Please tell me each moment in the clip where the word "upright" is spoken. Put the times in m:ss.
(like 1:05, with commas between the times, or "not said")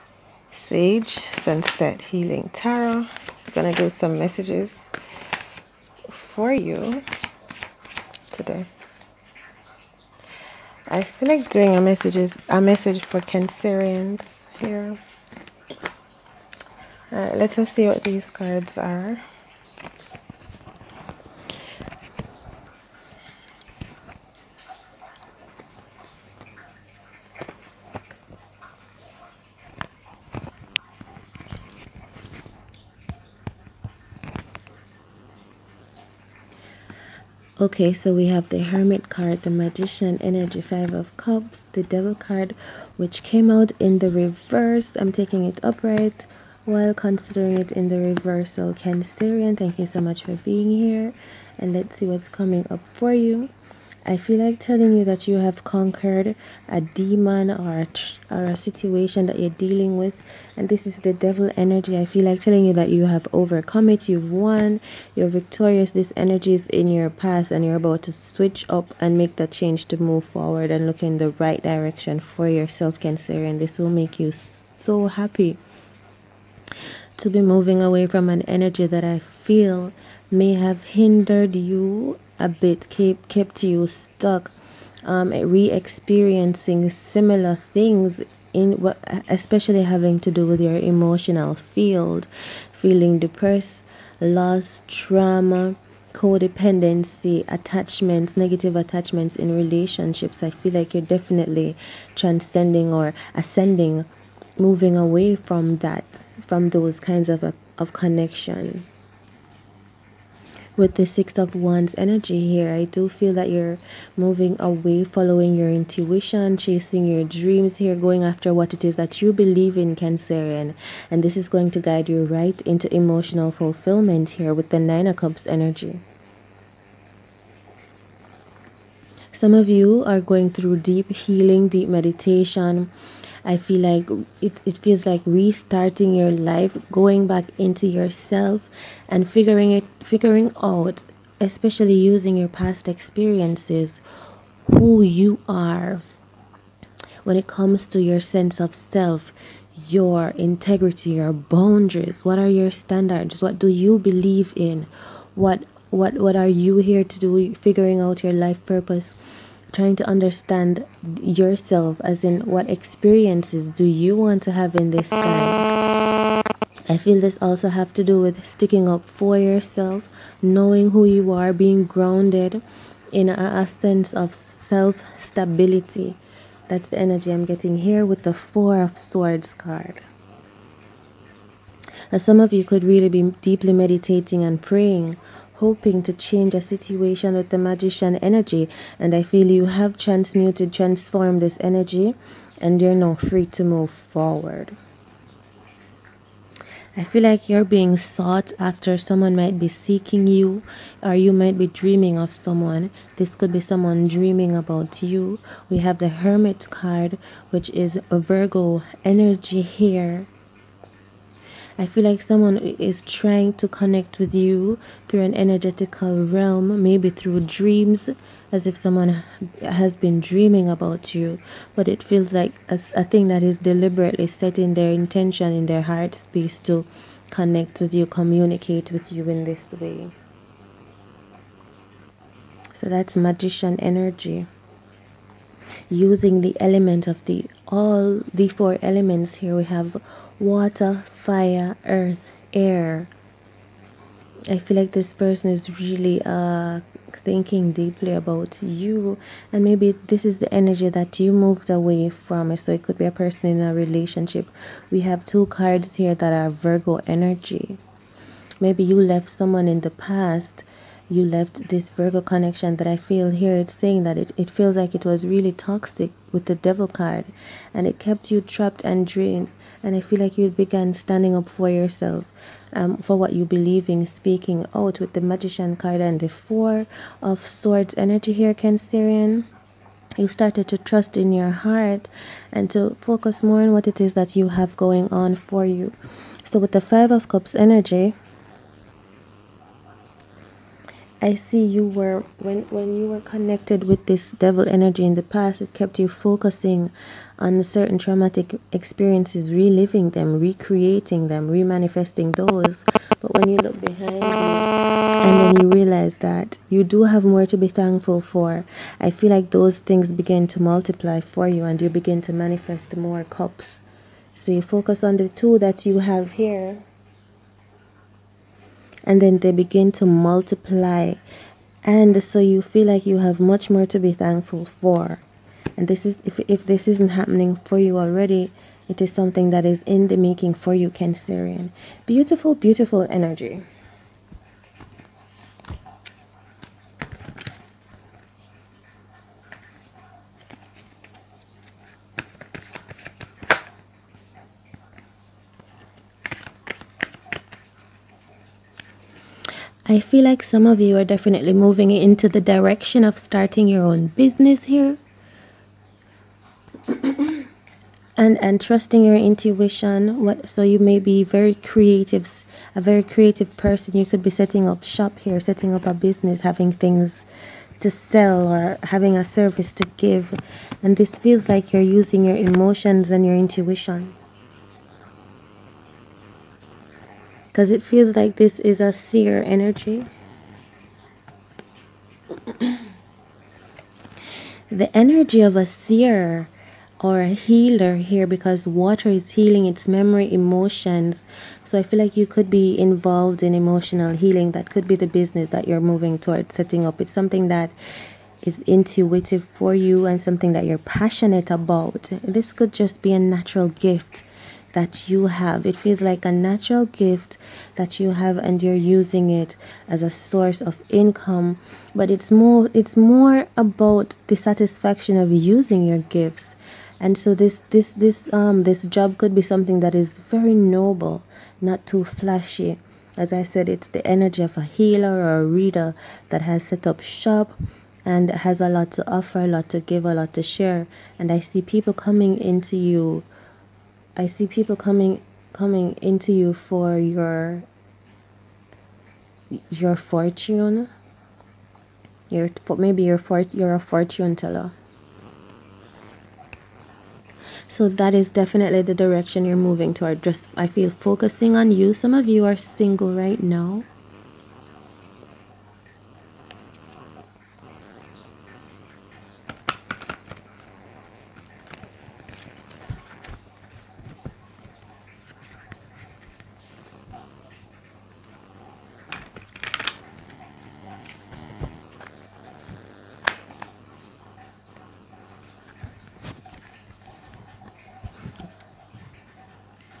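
0:45.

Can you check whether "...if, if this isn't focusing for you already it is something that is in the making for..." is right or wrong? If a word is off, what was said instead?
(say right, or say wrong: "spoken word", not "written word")
wrong: "happening", not "focusing".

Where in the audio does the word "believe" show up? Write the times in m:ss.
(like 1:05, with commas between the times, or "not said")
1:59, 2:33, 4:33.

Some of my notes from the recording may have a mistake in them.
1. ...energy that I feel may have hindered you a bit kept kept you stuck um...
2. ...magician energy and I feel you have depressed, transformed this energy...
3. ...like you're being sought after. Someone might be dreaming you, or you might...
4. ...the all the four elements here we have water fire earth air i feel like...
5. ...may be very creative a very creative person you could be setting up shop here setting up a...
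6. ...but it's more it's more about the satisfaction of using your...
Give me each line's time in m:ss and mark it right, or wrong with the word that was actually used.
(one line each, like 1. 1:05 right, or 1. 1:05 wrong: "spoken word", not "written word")
1. 1:18 right
2. 3:07 wrong: "transmuted", not "depressed"
3. 3:17 wrong: "seeking", not "dreaming"
4. 3:57 right
5. 6:00 right
6. 6:51 right.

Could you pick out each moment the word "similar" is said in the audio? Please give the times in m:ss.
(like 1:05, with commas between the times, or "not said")
1:26.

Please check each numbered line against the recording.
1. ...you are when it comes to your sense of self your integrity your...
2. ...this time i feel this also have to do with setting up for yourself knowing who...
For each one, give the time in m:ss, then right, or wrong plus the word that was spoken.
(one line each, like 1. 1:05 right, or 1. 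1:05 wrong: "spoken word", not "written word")
1. 2:25 right
2. 2:44 wrong: "sticking", not "setting".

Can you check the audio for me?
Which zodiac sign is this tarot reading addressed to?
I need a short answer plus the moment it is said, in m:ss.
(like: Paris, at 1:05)
Cancer, at 0:12.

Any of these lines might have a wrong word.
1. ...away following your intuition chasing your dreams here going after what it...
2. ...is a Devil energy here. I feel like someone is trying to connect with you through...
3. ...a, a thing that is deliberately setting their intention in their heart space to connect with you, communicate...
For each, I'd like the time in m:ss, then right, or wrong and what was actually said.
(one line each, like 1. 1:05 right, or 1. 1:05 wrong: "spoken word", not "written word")
1. 1:54 right
2. 3:27 wrong: "Virgo", not "Devil"
3. 3:42 right.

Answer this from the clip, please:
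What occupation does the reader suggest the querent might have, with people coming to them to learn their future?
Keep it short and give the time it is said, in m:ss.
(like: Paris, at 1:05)
Fortune teller, at 7:23.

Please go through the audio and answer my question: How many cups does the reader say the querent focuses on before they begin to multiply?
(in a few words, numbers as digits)
2.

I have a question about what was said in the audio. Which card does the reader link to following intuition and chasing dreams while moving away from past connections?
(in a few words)
Six of Wands.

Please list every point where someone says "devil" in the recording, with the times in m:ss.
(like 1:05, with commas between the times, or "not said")
0:41, 1:01, 4:26, 4:54.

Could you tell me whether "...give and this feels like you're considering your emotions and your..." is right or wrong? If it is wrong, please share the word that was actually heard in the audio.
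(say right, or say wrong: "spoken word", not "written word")
wrong: "using", not "considering".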